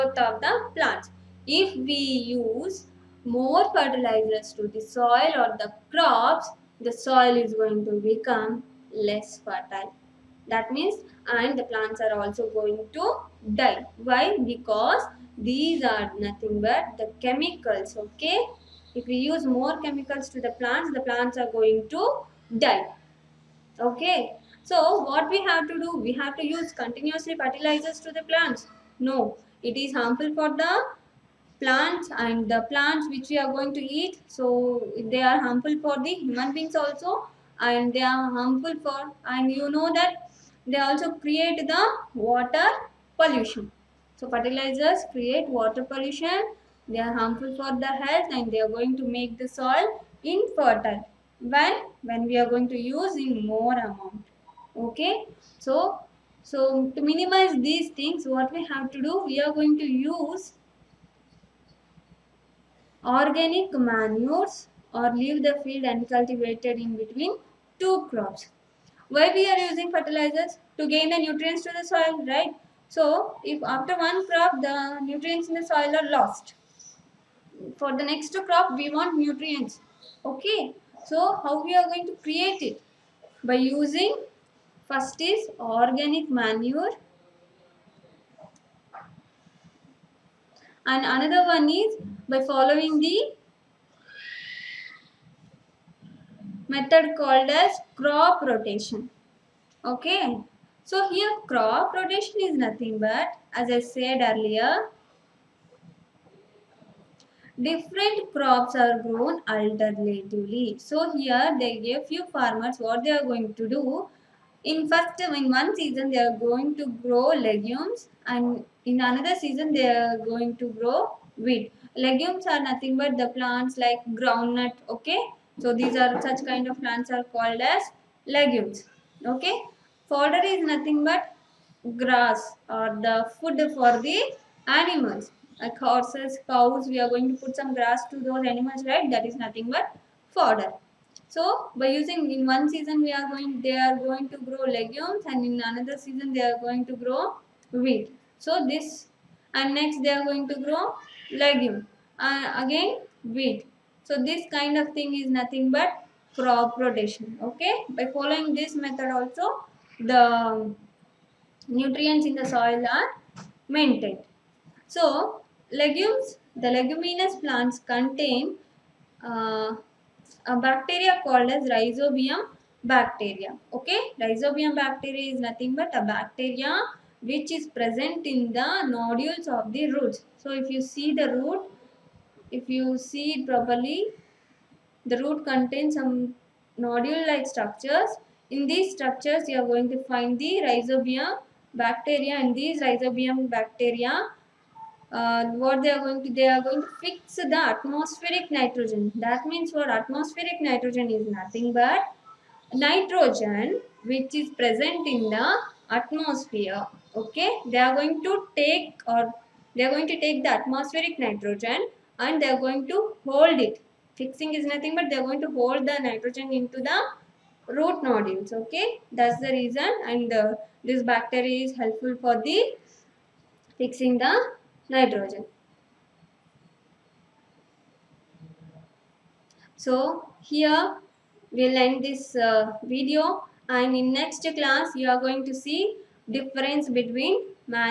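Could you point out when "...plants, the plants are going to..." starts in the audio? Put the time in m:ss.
0:20.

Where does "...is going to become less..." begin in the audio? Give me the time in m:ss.
0:07.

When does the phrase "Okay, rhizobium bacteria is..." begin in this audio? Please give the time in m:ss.
2:53.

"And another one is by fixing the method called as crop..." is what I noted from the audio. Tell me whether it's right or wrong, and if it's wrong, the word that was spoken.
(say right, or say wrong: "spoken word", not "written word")
wrong: "following", not "fixing".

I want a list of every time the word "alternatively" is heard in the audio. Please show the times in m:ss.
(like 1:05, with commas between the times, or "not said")
1:49.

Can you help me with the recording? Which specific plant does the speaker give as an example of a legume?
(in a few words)
groundnut.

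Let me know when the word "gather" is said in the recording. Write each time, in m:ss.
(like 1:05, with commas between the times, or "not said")
not said.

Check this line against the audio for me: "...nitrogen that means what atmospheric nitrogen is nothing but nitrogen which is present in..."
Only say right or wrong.
right.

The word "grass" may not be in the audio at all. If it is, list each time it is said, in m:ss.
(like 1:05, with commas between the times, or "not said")
2:11, 2:17.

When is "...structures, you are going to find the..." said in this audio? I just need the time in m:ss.
3:08.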